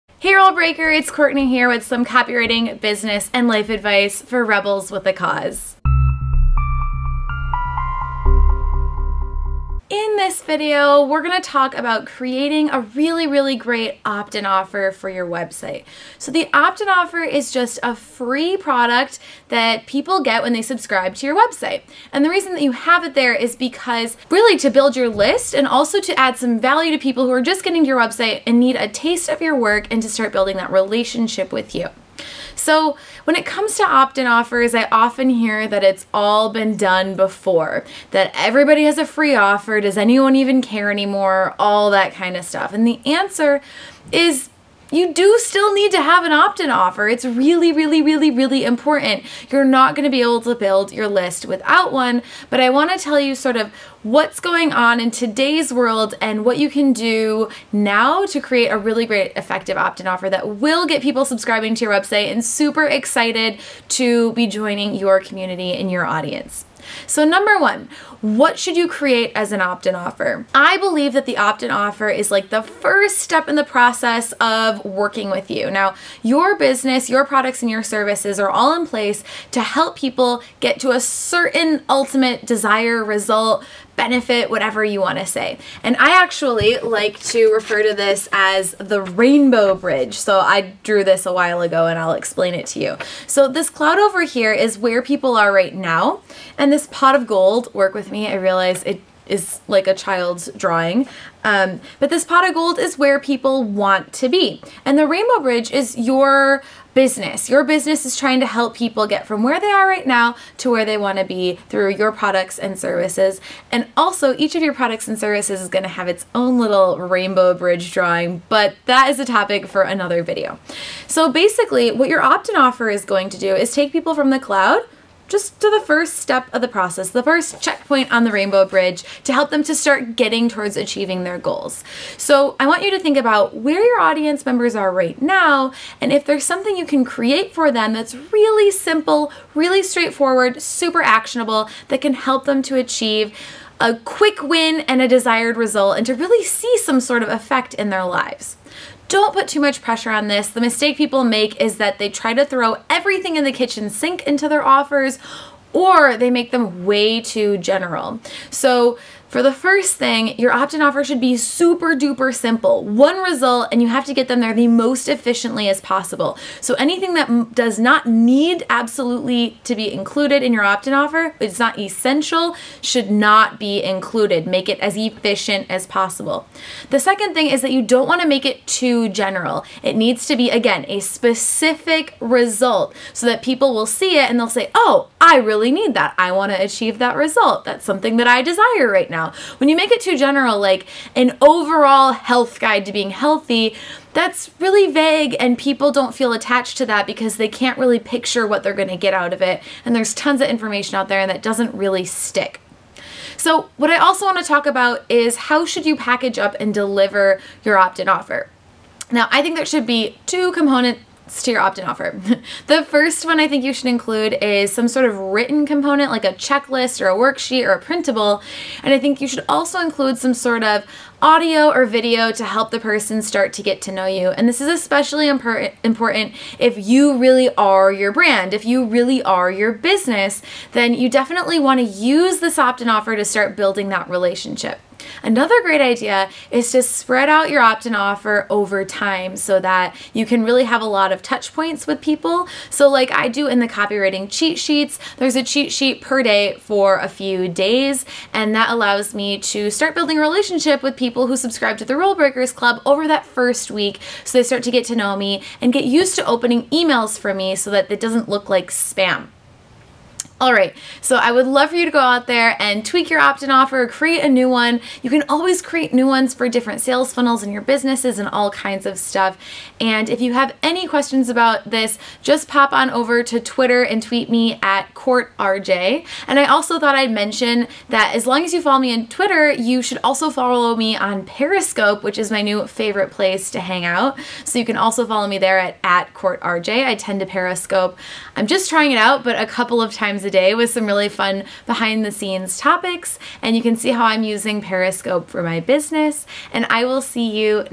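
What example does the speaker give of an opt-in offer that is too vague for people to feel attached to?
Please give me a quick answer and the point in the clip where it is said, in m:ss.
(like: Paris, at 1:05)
Overall health guide, at 3:11.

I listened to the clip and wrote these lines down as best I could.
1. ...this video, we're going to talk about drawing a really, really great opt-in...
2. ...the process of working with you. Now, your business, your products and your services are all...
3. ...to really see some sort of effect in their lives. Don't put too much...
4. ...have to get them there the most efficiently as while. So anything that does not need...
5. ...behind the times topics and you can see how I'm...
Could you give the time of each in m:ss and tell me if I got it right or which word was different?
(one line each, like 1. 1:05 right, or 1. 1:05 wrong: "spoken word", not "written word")
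1. 0:10 wrong: "creating", not "drawing"
2. 1:13 right
3. 2:26 right
4. 2:43 wrong: "possible", not "while"
5. 4:51 wrong: "scenes", not "times".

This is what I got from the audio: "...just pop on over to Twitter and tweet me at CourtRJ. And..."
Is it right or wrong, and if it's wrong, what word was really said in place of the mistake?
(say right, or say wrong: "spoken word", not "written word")
right.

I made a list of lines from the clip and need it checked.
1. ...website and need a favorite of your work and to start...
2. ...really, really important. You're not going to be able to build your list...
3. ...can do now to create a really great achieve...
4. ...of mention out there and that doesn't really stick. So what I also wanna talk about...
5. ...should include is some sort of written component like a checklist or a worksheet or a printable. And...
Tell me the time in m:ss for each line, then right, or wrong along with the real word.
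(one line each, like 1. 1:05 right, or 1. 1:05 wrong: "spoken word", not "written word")
1. 0:27 wrong: "taste", not "favorite"
2. 0:48 right
3. 0:56 wrong: "effective", not "achieve"
4. 3:20 wrong: "information", not "mention"
5. 3:33 right.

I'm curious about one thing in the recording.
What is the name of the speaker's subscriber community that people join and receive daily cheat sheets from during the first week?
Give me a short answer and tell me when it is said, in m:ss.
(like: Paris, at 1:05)
Rule Breakers Club, at 4:11.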